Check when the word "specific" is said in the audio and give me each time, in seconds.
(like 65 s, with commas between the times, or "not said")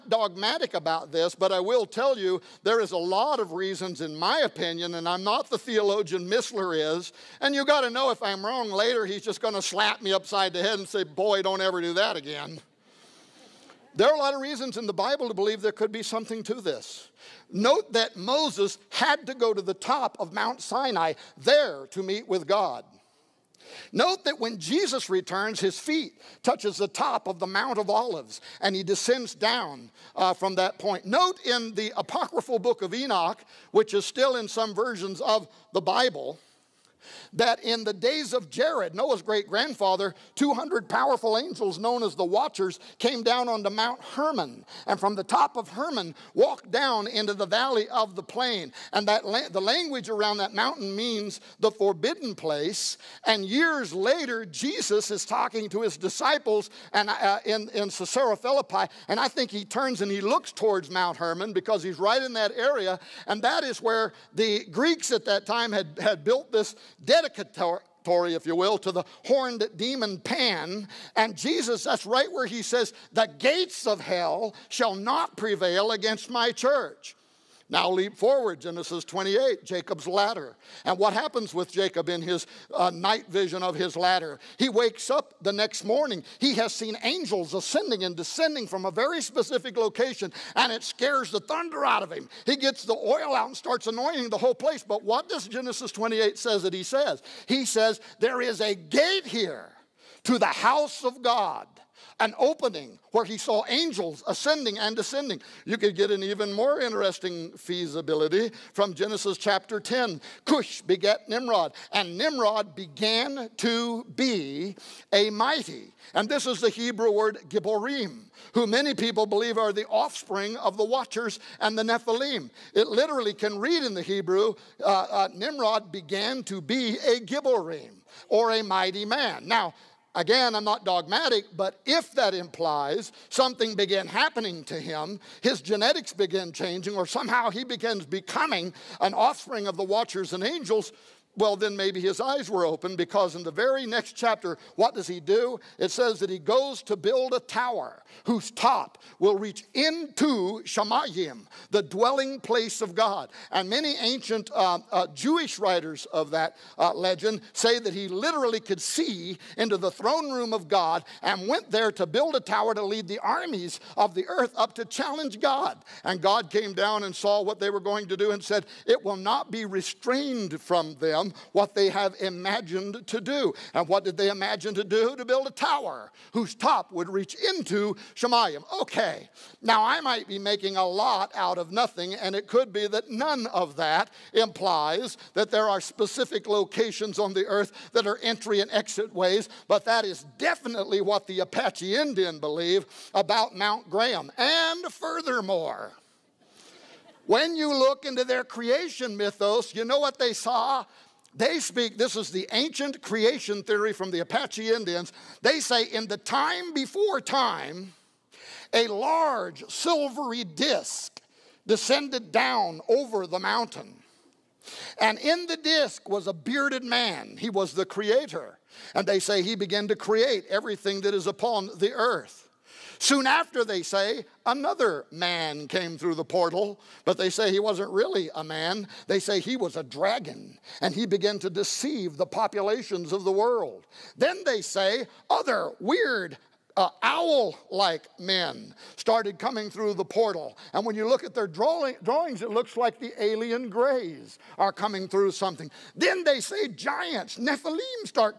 89 s, 185 s.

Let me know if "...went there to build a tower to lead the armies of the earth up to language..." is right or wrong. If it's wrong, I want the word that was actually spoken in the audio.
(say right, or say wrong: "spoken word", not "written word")
wrong: "challenge", not "language".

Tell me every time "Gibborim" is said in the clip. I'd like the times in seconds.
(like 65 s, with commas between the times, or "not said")
117 s, 127 s.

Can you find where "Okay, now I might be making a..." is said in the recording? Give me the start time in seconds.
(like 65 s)
178 s.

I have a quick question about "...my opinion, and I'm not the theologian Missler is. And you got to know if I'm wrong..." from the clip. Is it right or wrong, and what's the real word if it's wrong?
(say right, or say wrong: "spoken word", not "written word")
right.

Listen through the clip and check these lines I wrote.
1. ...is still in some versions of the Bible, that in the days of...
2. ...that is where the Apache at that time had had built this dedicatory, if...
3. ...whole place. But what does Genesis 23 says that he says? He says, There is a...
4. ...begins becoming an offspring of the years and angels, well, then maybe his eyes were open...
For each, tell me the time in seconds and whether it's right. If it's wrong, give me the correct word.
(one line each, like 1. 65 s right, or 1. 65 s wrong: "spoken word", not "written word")
1. 33 s right
2. 63 s wrong: "Greeks", not "Apache"
3. 94 s wrong: "28", not "23"
4. 137 s wrong: "watchers", not "years".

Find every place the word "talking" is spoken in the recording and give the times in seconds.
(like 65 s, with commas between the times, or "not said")
55 s.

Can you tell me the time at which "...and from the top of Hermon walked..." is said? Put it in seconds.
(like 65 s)
44 s.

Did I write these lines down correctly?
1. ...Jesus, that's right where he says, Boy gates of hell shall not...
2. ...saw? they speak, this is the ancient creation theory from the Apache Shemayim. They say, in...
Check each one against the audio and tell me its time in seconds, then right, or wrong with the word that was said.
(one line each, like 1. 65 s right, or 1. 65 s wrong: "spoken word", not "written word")
1. 71 s wrong: "The", not "Boy"
2. 200 s wrong: "Indians", not "Shemayim".